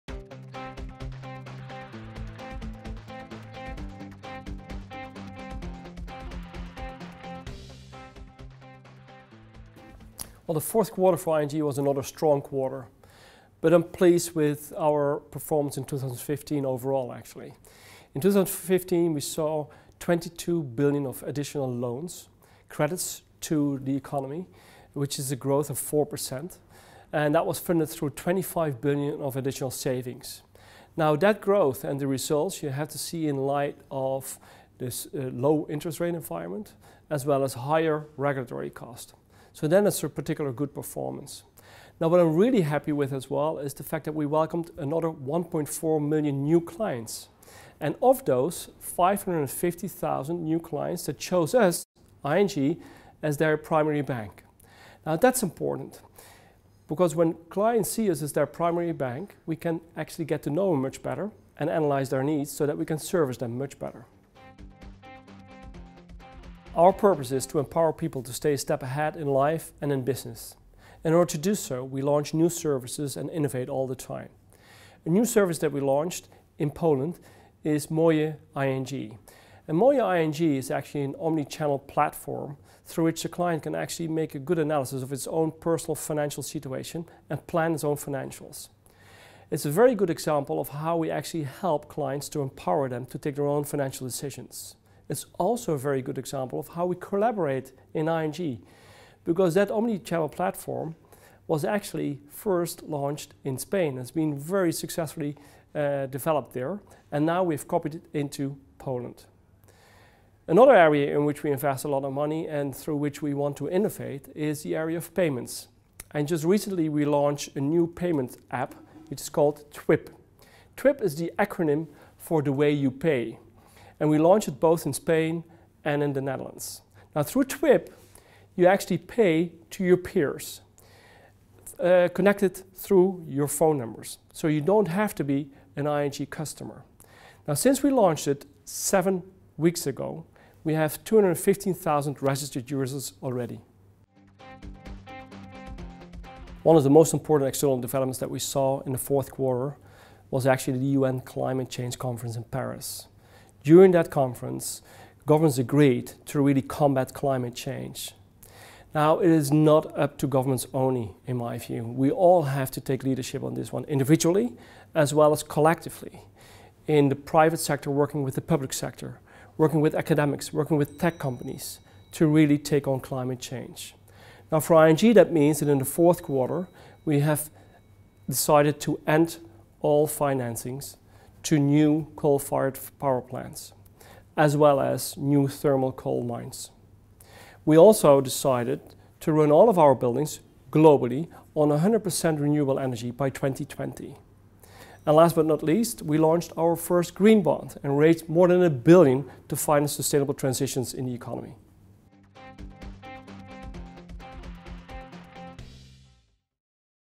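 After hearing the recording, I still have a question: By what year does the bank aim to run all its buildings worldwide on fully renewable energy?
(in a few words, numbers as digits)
2020.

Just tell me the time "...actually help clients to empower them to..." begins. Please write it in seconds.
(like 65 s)
91 s.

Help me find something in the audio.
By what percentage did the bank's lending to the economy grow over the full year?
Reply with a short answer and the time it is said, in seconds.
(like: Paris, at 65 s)
4%, at 25 s.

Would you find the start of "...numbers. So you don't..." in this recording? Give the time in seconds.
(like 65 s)
133 s.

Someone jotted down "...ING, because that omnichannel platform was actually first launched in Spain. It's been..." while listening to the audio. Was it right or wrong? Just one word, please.
right.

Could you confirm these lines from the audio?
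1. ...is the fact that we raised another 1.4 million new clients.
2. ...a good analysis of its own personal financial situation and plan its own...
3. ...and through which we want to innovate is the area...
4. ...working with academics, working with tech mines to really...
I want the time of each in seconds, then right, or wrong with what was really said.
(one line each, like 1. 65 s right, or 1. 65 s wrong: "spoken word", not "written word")
1. 43 s wrong: "welcomed", not "raised"
2. 84 s right
3. 112 s right
4. 169 s wrong: "companies", not "mines".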